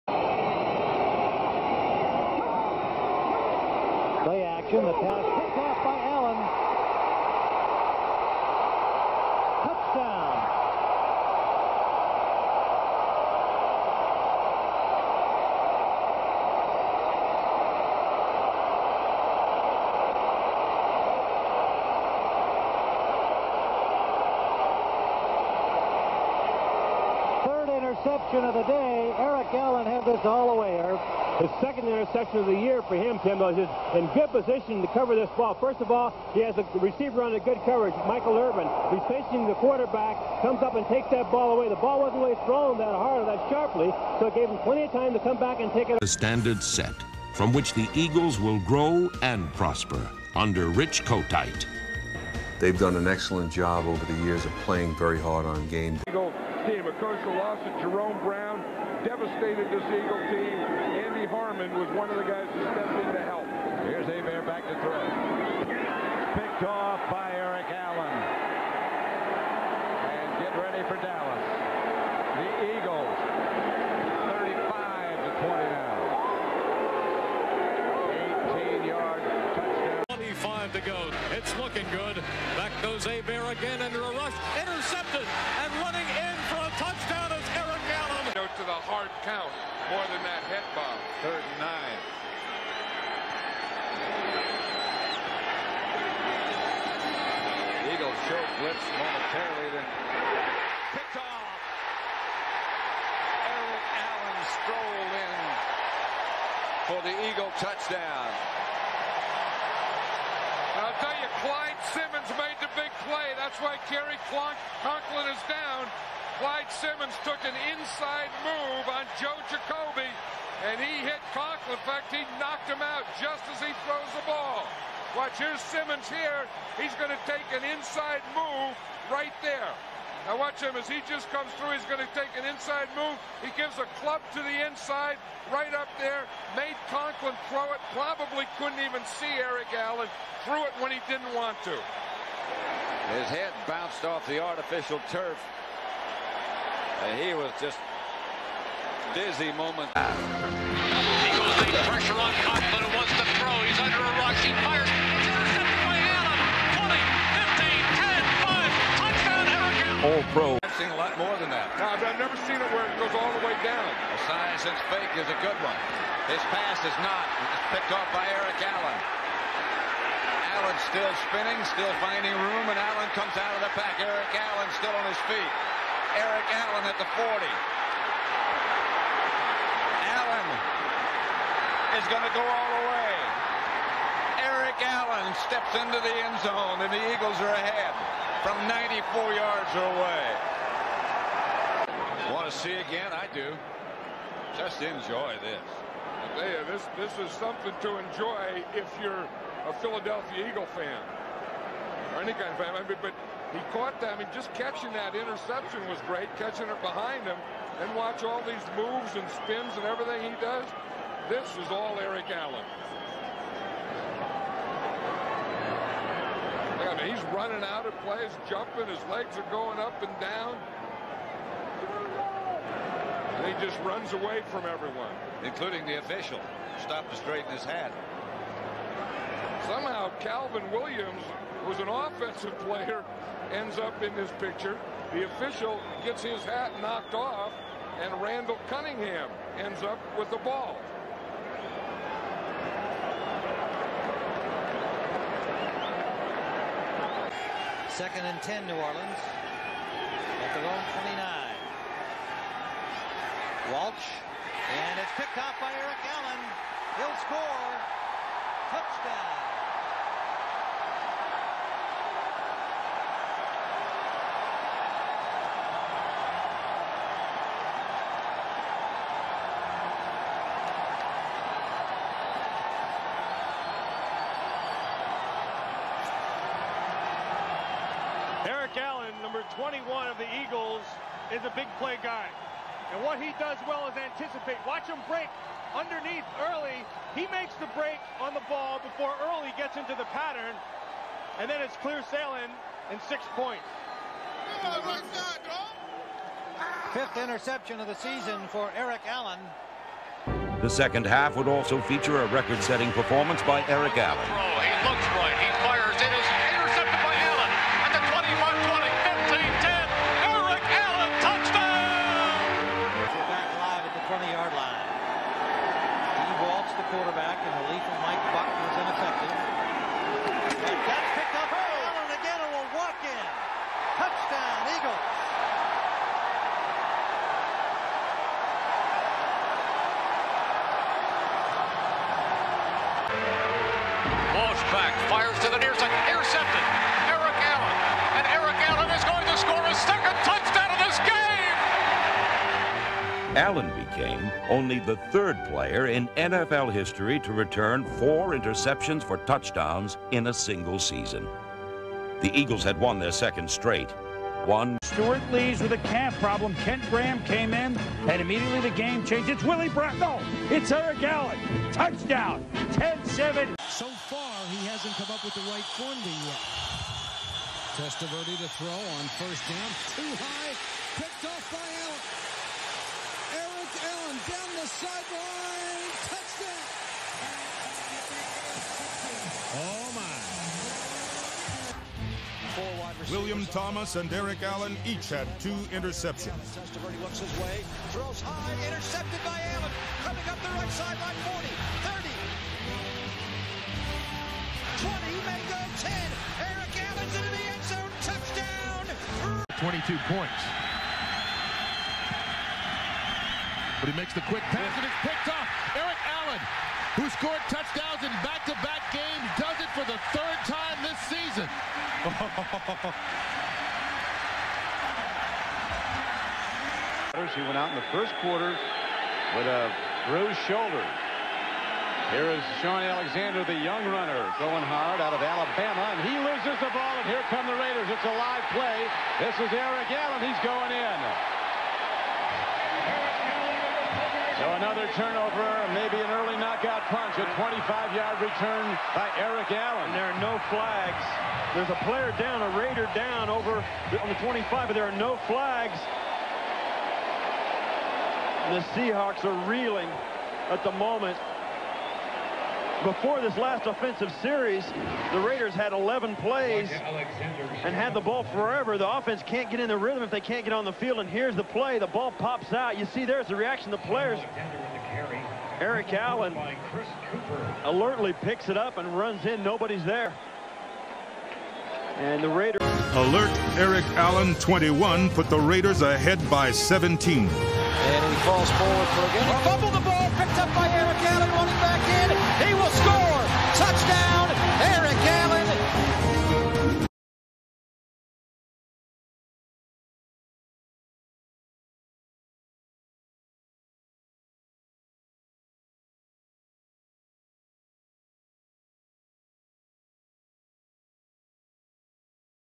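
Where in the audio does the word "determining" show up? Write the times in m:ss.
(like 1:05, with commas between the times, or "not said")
not said.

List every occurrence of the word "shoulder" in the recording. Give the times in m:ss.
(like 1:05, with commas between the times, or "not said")
7:00.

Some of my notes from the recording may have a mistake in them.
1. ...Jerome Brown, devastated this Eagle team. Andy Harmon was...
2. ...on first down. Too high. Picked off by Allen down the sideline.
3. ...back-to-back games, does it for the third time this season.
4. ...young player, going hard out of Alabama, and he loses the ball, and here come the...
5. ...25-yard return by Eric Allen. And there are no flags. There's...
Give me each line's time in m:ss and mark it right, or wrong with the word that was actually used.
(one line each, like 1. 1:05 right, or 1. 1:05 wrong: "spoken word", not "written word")
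1. 0:57 right
2. 6:08 right
3. 6:48 right
4. 7:03 wrong: "runner", not "player"
5. 7:17 right.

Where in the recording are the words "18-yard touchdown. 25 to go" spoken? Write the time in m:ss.
1:18.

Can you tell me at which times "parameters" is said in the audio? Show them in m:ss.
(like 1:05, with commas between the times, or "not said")
not said.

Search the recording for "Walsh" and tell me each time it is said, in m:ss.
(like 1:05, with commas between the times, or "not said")
4:13, 5:34.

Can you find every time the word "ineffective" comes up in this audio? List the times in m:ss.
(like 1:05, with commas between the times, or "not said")
5:18.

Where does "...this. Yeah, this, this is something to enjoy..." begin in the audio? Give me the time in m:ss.
3:15.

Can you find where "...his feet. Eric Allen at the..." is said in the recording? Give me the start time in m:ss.
2:55.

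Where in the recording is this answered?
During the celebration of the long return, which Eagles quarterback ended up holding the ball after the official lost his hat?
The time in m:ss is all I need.
3:58.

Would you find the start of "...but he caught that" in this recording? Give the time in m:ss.
3:23.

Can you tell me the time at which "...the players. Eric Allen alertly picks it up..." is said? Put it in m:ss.
7:43.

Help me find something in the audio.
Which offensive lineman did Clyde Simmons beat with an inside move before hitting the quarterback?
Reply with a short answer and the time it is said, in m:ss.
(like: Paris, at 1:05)
Joe Jacoby, at 1:59.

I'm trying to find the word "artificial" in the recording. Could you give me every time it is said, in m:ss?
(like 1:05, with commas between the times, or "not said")
2:24.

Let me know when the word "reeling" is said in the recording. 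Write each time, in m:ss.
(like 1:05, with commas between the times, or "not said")
7:29.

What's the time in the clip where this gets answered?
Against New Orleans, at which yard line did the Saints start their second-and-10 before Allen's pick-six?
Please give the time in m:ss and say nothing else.
4:11.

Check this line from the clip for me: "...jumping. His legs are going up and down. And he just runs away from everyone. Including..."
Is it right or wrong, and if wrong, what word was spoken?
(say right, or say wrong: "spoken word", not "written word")
right.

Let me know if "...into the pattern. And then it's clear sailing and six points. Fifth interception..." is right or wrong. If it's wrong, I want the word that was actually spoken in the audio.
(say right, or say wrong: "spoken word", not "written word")
right.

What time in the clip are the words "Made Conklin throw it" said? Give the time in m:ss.
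2:16.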